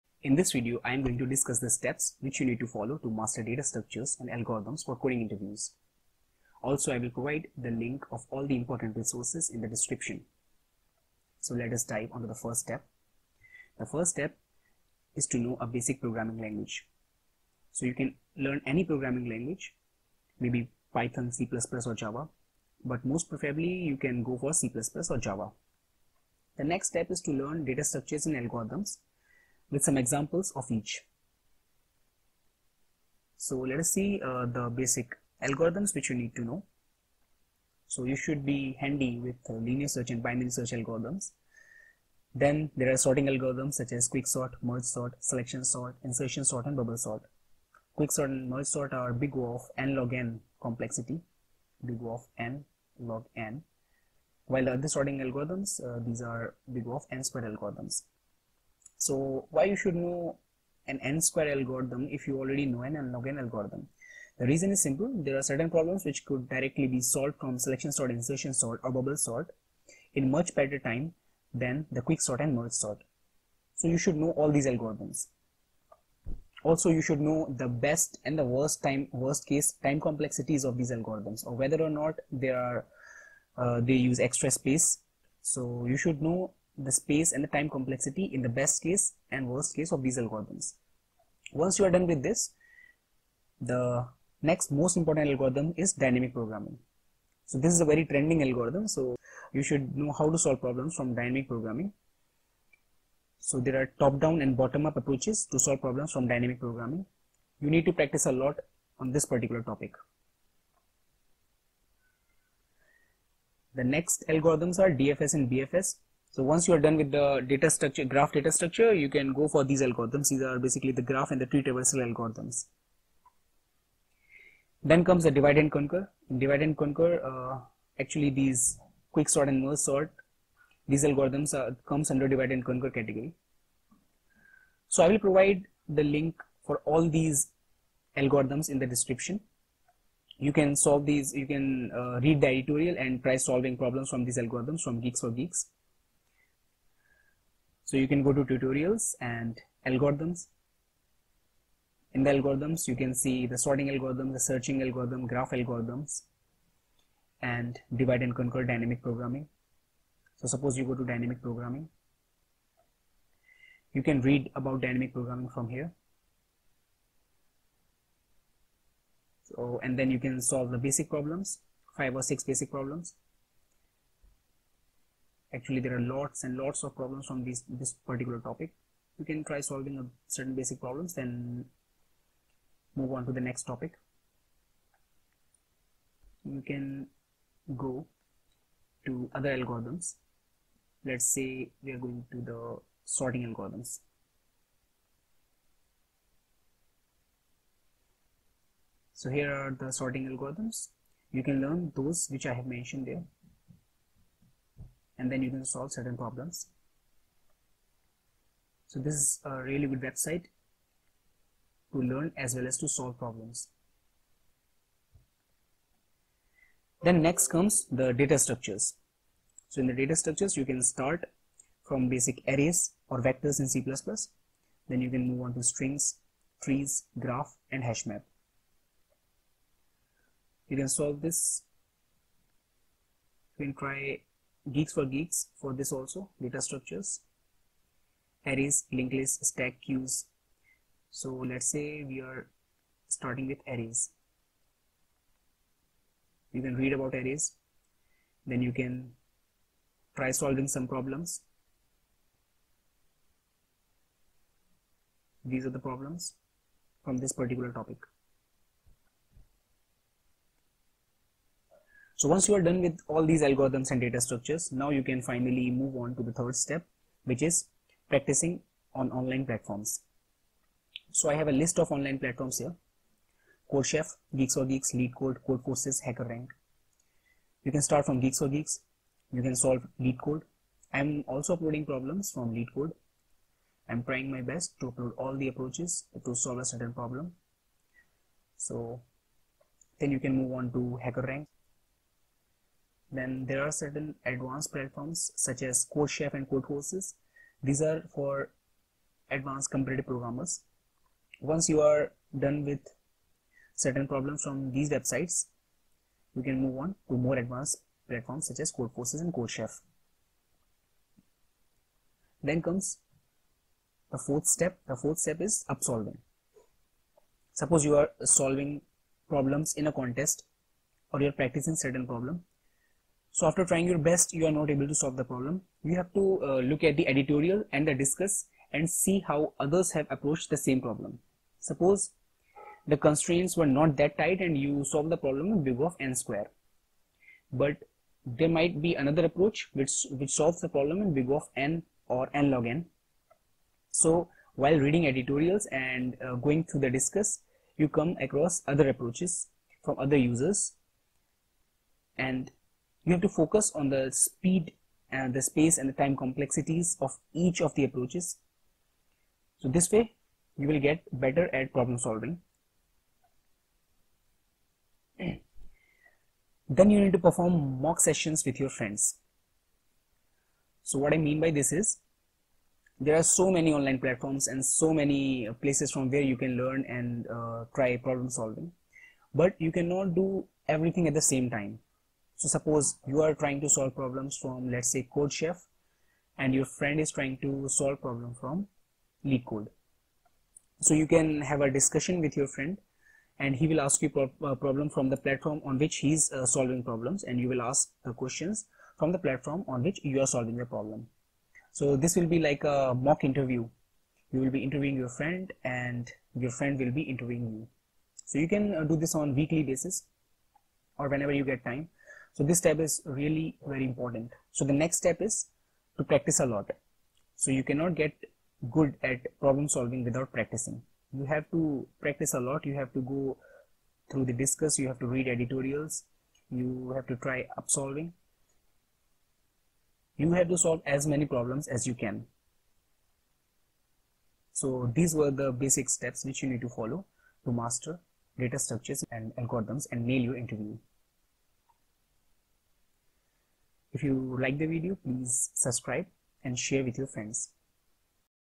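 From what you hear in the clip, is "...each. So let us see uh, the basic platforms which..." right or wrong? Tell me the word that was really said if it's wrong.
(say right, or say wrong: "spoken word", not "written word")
wrong: "algorithms", not "platforms".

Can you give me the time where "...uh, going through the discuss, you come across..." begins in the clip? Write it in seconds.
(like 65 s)
346 s.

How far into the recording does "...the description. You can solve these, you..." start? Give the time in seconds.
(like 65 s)
138 s.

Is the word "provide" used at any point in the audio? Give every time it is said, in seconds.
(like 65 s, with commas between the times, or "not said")
7 s, 135 s.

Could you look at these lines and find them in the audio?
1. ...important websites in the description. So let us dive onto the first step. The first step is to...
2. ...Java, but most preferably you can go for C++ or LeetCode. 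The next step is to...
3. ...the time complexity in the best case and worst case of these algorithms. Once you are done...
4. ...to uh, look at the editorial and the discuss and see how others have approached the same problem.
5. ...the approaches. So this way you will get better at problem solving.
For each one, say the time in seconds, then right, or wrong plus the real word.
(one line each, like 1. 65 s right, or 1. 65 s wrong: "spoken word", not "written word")
1. 8 s wrong: "resources", not "websites"
2. 21 s wrong: "Java", not "LeetCode"
3. 87 s right
4. 326 s right
5. 357 s right.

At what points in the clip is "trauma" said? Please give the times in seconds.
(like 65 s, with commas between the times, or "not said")
not said.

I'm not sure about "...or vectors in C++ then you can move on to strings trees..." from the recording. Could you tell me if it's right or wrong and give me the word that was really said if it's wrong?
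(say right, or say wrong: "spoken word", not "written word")
right.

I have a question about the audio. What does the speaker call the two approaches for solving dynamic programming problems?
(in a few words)
Top-down and bottom-up.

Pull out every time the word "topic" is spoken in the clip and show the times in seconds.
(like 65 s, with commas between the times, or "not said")
109 s, 178 s, 183 s, 257 s.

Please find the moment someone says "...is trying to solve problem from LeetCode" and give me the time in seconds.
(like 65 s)
386 s.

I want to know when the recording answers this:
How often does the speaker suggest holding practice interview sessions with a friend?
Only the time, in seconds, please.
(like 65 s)
409 s.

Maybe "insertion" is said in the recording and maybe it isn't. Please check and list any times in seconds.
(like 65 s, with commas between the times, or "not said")
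46 s, 68 s.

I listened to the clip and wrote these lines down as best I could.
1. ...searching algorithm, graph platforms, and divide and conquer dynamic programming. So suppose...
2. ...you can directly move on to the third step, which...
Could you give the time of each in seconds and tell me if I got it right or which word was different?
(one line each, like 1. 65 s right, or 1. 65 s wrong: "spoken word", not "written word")
1. 154 s wrong: "algorithms", not "platforms"
2. 264 s wrong: "finally", not "directly".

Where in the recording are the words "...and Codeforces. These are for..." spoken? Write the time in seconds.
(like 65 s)
296 s.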